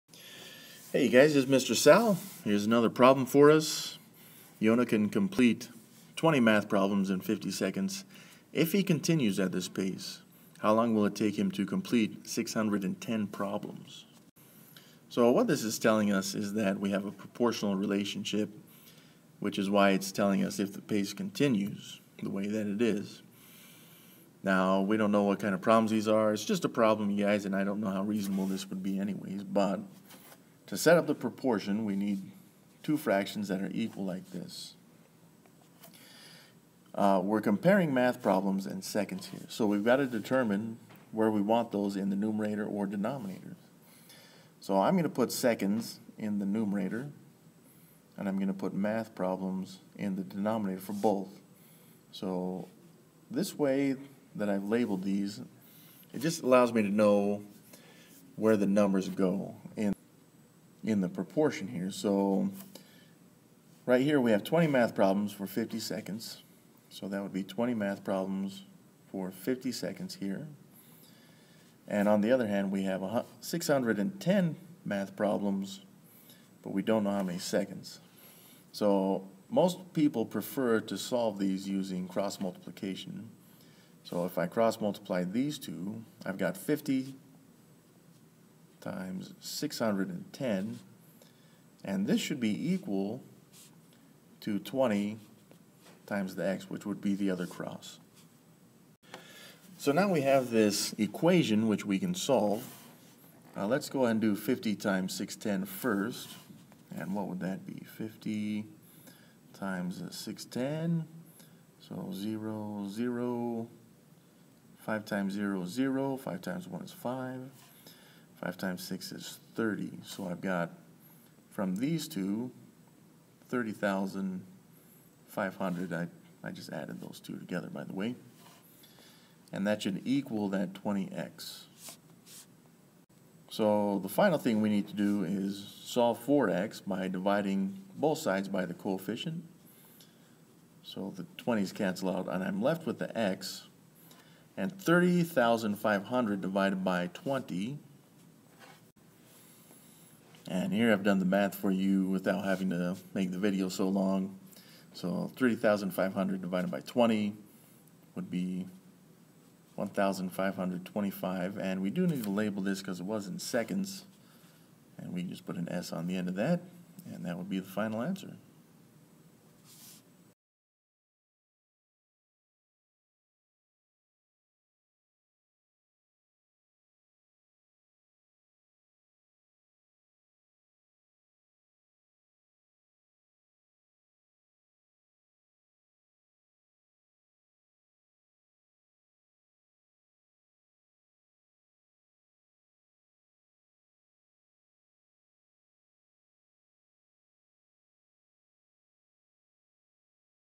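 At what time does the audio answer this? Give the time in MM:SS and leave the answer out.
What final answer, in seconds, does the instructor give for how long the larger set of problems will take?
02:39.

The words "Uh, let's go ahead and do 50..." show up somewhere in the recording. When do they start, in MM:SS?
01:43.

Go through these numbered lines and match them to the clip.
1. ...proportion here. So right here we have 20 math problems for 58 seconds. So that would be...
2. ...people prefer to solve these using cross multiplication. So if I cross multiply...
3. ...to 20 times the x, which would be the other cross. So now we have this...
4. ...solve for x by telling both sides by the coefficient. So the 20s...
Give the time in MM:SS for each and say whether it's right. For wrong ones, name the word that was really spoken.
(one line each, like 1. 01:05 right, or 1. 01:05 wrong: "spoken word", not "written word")
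1. 01:01 wrong: "50", not "58"
2. 01:19 right
3. 01:34 right
4. 02:15 wrong: "dividing", not "telling".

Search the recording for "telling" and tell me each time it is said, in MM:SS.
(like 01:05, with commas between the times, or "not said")
00:15, 00:20.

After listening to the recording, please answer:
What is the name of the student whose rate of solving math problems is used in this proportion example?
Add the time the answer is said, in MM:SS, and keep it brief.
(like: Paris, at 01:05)
Yona, at 00:04.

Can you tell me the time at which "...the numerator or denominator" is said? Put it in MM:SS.
00:42.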